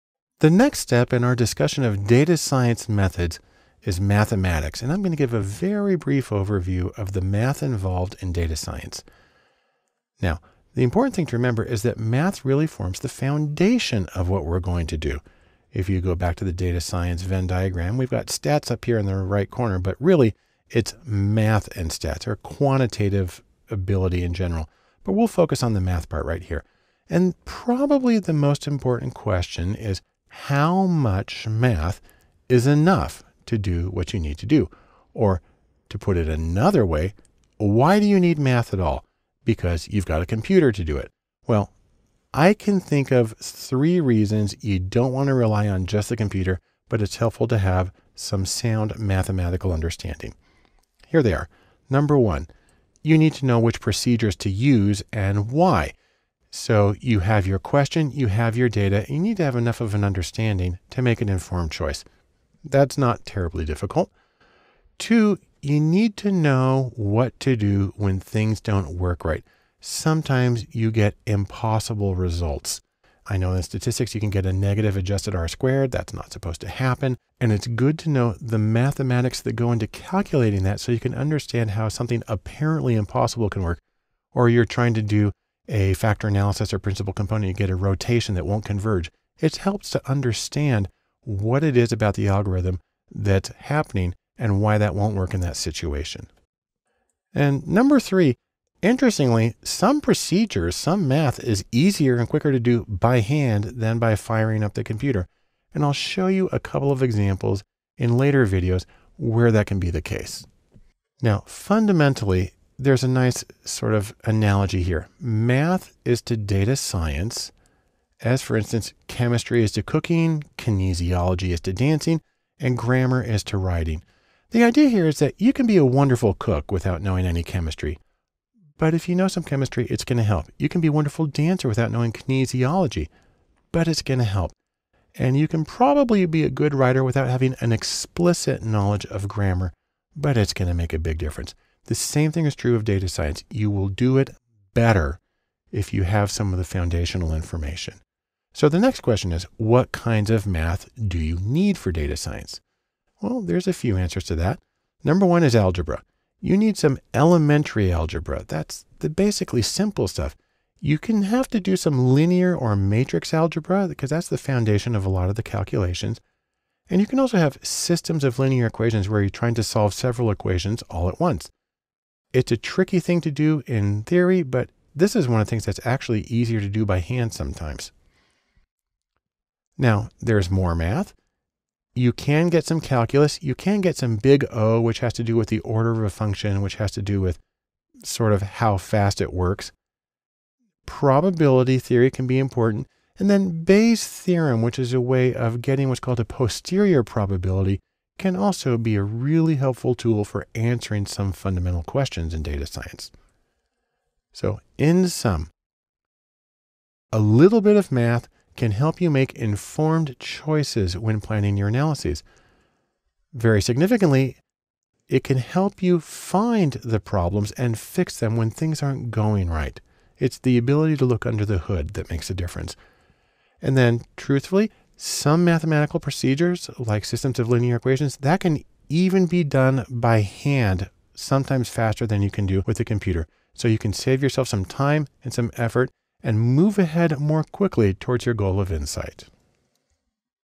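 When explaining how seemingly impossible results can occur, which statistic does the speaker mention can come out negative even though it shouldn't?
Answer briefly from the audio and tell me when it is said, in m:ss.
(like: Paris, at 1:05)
adjusted R squared, at 1:14.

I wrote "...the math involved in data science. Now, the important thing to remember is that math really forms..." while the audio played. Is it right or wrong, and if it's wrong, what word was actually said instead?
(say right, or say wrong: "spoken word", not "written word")
right.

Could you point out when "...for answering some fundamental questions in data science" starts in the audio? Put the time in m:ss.
3:20.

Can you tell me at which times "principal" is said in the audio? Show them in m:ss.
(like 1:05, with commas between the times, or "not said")
1:26.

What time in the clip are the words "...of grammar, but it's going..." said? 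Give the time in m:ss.
2:19.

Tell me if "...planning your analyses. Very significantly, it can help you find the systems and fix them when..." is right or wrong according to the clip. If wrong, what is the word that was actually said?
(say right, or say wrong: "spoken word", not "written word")
wrong: "problems", not "systems".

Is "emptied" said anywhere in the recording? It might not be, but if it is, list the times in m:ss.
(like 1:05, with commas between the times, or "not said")
not said.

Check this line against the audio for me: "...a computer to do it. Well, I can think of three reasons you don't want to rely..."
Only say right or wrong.
right.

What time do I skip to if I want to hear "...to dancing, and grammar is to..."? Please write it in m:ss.
2:01.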